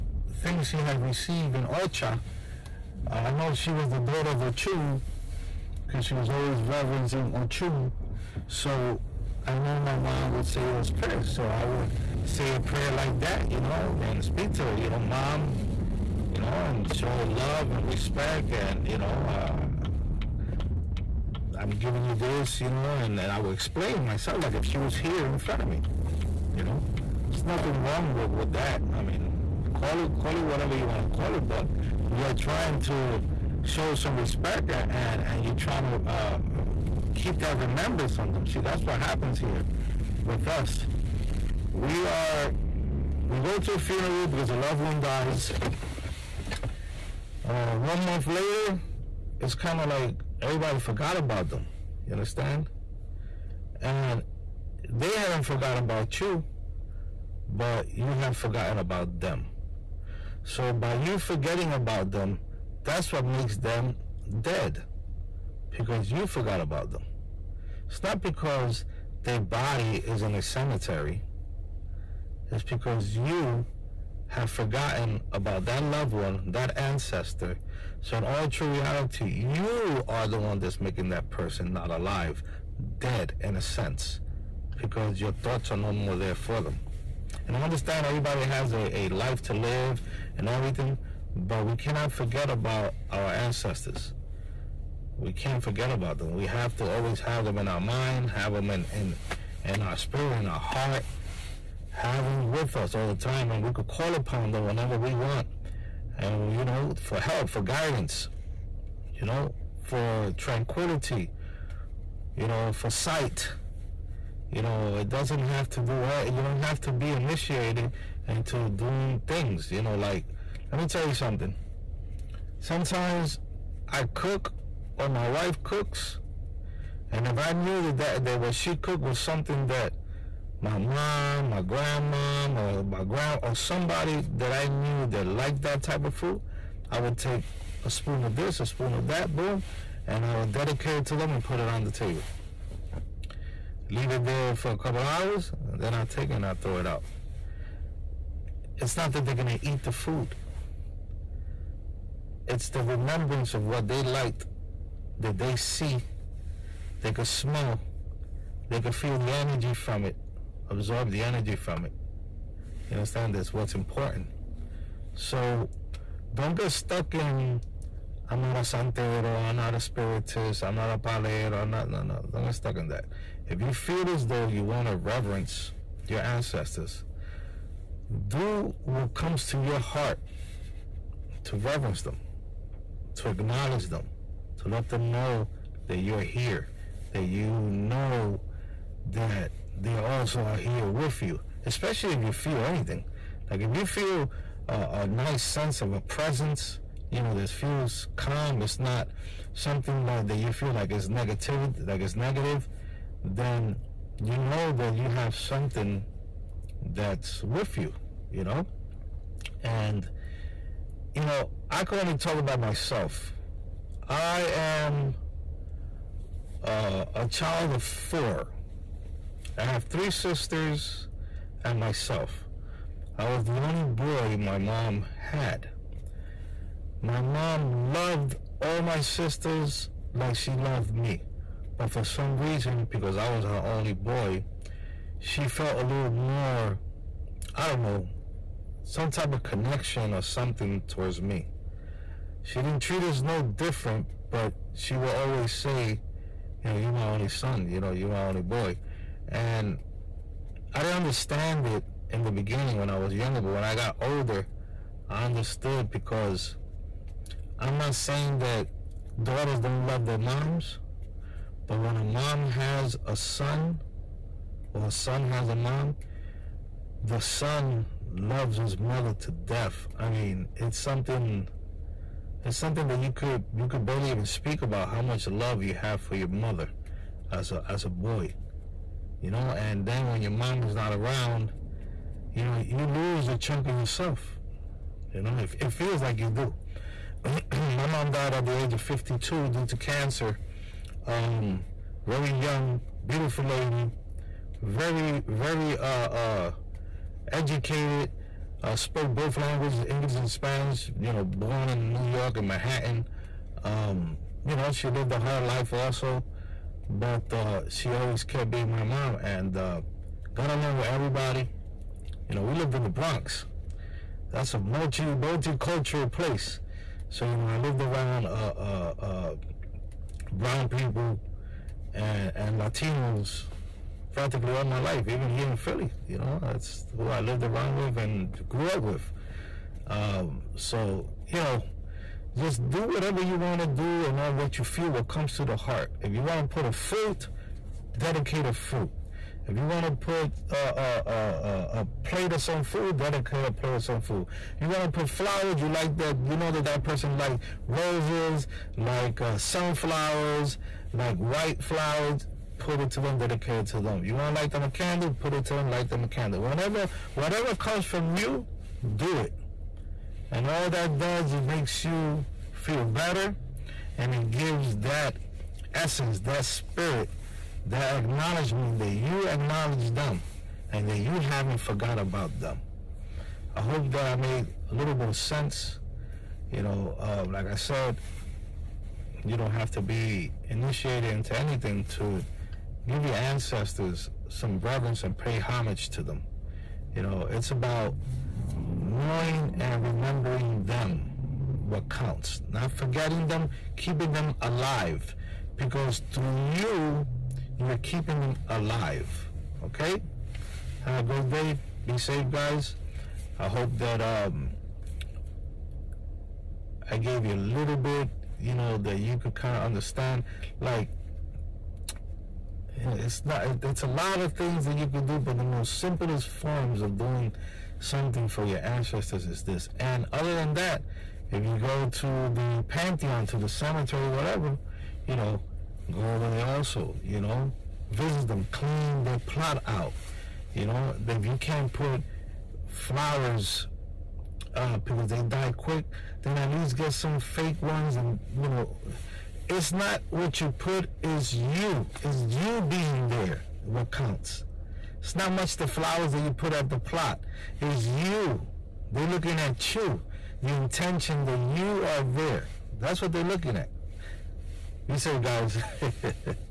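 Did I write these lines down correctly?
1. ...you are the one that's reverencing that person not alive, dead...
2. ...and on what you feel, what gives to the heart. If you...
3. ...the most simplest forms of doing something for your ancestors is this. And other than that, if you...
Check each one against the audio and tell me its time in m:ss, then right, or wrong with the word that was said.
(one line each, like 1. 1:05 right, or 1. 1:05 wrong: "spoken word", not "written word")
1. 1:19 wrong: "making", not "reverencing"
2. 5:34 wrong: "comes", not "gives"
3. 6:55 right.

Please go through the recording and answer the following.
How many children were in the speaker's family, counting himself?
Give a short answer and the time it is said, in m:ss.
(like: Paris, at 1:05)
4, at 3:37.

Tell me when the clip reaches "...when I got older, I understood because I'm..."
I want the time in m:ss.
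4:13.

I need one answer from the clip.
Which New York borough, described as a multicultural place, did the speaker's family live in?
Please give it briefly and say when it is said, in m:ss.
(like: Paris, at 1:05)
The Bronx, at 5:12.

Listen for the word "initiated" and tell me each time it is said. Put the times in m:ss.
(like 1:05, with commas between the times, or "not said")
1:57, 6:20.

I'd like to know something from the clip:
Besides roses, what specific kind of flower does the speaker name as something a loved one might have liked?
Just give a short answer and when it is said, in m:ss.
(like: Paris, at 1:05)
Sunflowers, at 5:49.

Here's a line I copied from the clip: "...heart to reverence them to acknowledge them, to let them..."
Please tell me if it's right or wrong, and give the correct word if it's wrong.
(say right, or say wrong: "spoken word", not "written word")
right.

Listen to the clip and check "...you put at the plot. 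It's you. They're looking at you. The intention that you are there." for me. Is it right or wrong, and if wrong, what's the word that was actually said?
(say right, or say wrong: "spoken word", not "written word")
right.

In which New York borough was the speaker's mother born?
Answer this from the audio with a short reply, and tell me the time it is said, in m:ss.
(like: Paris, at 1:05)
Manhattan, at 5:02.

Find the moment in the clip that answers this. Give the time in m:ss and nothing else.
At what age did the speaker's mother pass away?
4:48.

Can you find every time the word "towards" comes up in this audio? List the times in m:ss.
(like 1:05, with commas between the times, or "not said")
4:00.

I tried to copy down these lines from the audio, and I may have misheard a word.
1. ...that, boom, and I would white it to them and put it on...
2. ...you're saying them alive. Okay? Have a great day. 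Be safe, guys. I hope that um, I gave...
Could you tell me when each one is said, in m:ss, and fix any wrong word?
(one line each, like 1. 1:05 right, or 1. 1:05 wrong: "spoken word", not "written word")
1. 2:19 wrong: "dedicate", not "white"
2. 6:37 wrong: "keeping", not "saying".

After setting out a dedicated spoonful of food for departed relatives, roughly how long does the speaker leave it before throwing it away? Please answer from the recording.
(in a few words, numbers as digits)
A couple hours.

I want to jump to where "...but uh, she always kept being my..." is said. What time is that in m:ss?
5:06.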